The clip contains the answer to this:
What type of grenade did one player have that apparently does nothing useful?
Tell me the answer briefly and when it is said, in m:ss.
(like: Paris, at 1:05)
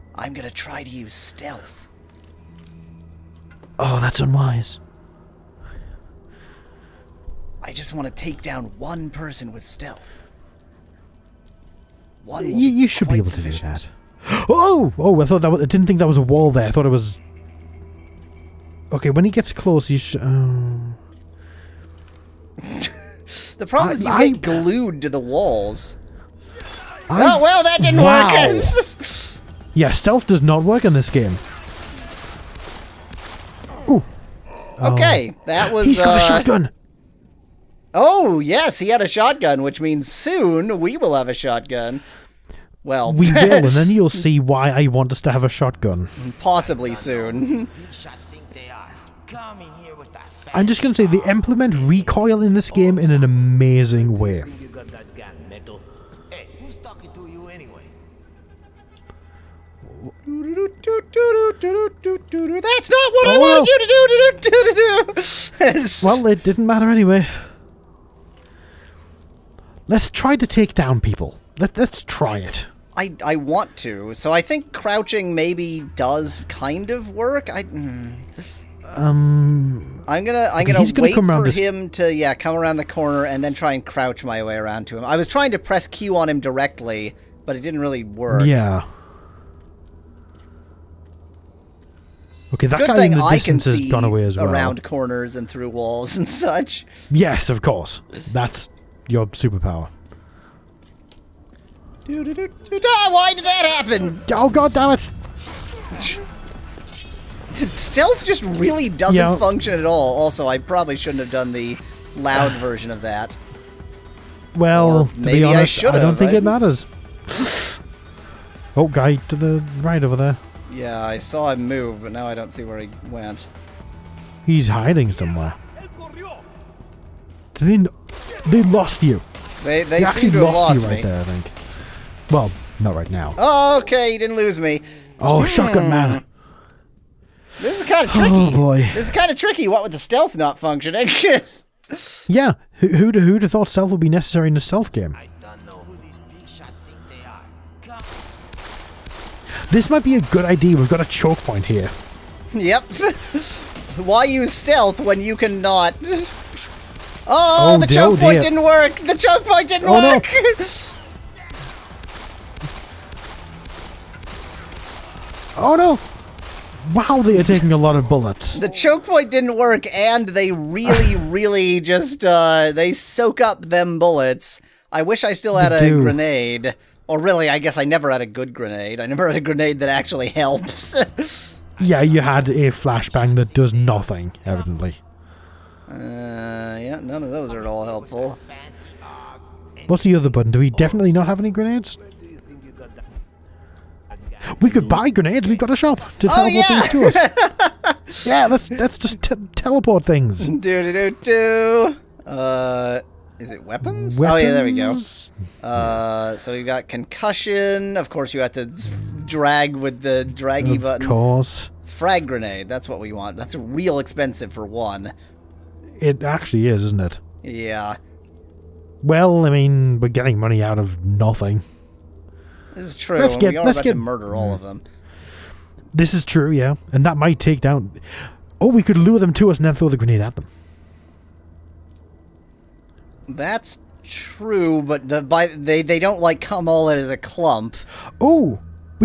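Flashbang, at 3:02.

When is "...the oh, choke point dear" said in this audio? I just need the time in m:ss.
2:37.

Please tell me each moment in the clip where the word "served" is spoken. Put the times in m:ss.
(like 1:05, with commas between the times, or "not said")
not said.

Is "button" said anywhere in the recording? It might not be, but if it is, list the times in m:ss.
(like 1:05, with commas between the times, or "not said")
3:10, 3:30.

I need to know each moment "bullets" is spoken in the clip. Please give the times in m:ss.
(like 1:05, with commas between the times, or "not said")
2:48, 2:53.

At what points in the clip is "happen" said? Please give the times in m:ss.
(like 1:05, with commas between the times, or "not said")
1:43.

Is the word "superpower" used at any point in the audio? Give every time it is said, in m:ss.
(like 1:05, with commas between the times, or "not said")
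1:39.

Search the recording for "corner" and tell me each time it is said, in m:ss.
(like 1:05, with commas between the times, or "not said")
1:22, 1:34.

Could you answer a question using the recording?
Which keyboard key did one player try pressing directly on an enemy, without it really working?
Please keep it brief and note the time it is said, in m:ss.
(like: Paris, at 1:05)
Q, at 1:25.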